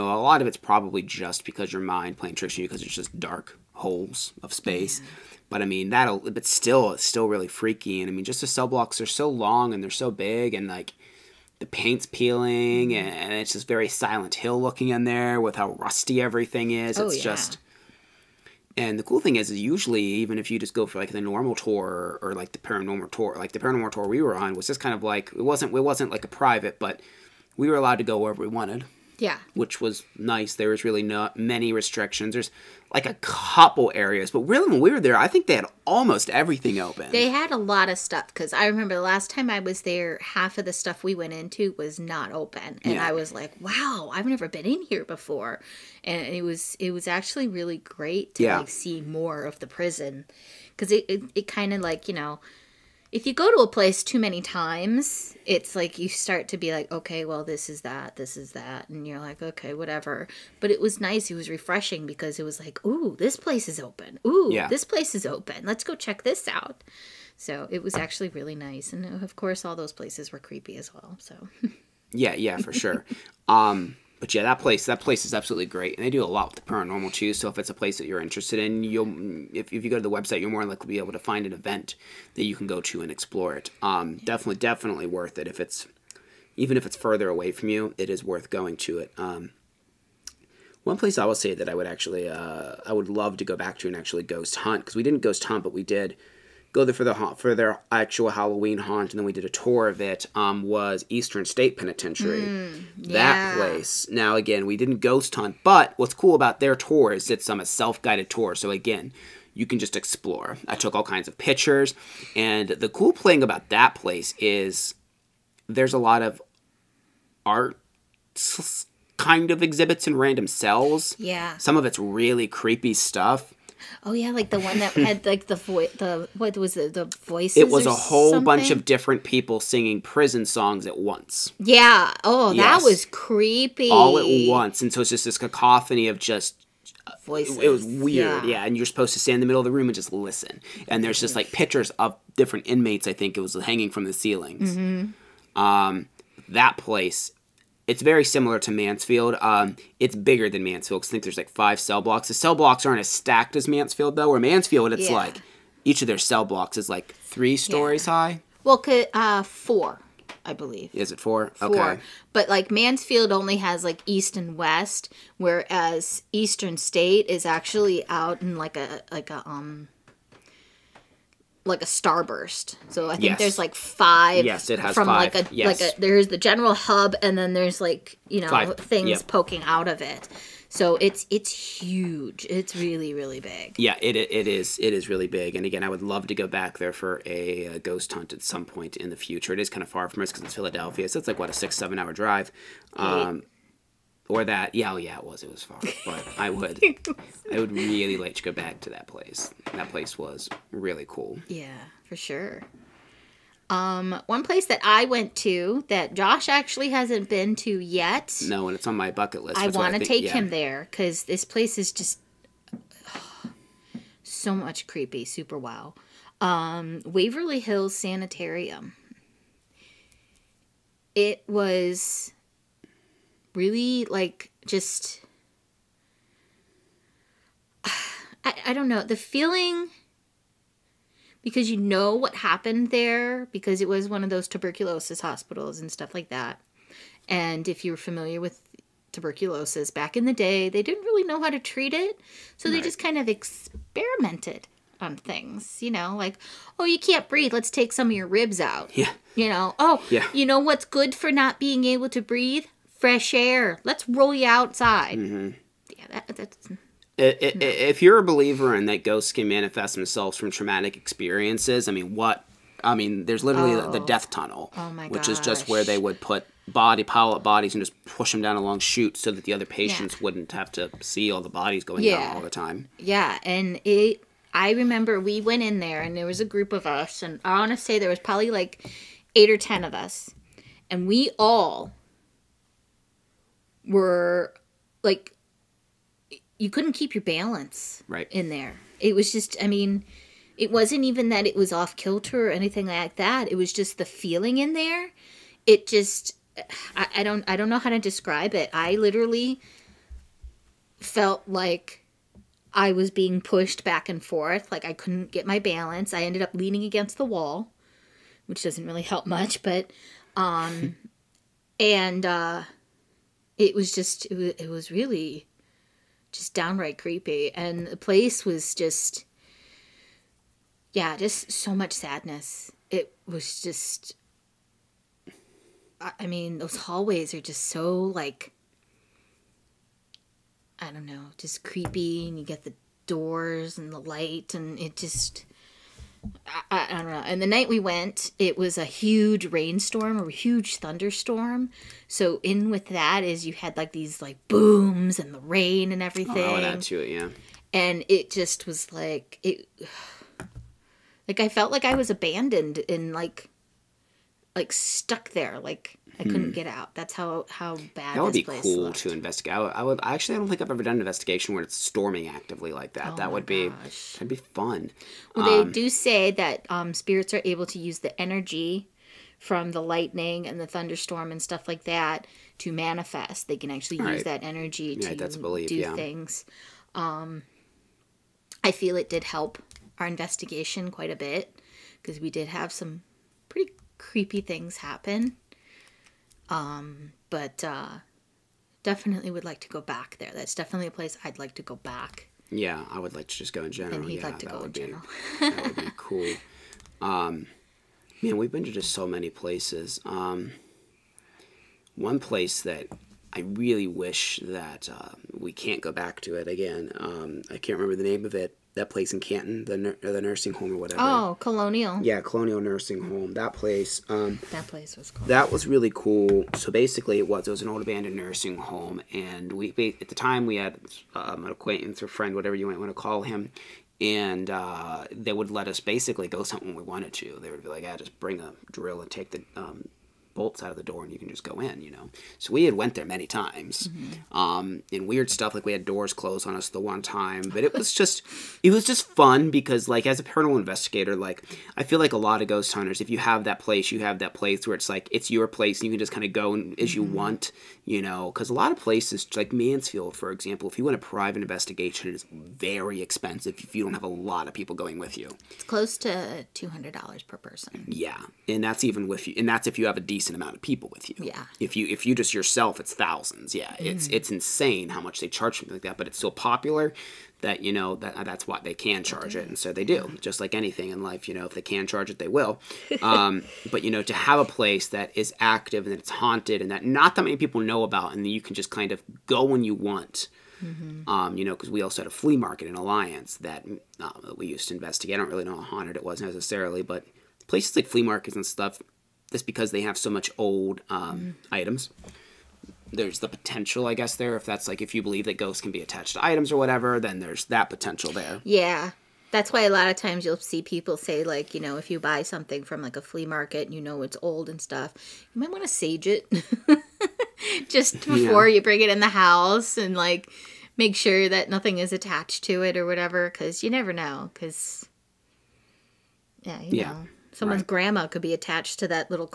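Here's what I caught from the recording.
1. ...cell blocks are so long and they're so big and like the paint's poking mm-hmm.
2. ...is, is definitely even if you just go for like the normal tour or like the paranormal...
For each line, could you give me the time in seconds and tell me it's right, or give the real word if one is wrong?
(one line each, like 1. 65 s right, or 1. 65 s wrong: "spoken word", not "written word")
1. 8 s wrong: "peeling", not "poking"
2. 19 s wrong: "usually", not "definitely".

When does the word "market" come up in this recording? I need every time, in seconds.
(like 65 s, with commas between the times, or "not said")
482 s, 488 s, 503 s.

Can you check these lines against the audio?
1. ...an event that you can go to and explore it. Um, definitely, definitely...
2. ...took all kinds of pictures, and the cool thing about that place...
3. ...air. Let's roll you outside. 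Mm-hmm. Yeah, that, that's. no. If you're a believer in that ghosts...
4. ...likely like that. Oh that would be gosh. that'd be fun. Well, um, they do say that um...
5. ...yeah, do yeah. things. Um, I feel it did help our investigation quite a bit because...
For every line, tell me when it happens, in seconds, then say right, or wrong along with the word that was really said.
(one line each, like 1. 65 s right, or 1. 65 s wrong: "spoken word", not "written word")
1. 81 s right
2. 110 s right
3. 253 s right
4. 362 s wrong: "actively", not "likely"
5. 375 s right.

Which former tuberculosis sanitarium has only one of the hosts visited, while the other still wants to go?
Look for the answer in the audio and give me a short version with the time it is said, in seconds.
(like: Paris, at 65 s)
Waverly Hills Sanitarium, at 217 s.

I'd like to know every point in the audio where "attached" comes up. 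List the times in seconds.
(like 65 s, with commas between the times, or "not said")
495 s, 511 s, 518 s.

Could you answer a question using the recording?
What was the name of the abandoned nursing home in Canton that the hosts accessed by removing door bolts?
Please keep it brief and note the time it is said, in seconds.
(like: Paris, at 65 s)
Colonial Nursing Home, at 412 s.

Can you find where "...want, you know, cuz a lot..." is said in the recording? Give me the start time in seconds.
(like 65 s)
447 s.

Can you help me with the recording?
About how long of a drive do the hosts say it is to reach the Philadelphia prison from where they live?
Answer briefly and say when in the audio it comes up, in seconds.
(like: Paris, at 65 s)
6 or 7 hours, at 191 s.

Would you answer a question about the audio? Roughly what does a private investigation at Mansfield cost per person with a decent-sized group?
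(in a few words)
$200.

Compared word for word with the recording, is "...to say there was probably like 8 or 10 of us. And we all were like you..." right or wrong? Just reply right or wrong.
right.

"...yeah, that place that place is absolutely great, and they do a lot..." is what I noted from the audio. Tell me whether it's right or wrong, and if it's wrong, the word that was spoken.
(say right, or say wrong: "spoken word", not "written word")
right.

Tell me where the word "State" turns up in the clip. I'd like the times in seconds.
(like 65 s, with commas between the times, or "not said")
101 s, 166 s.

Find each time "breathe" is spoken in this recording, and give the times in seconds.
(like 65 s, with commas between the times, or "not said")
247 s, 252 s.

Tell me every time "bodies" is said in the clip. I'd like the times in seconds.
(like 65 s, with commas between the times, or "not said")
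267 s, 271 s.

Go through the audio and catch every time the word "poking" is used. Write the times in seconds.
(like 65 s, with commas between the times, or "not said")
179 s.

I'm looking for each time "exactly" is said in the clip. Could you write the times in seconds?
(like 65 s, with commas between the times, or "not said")
not said.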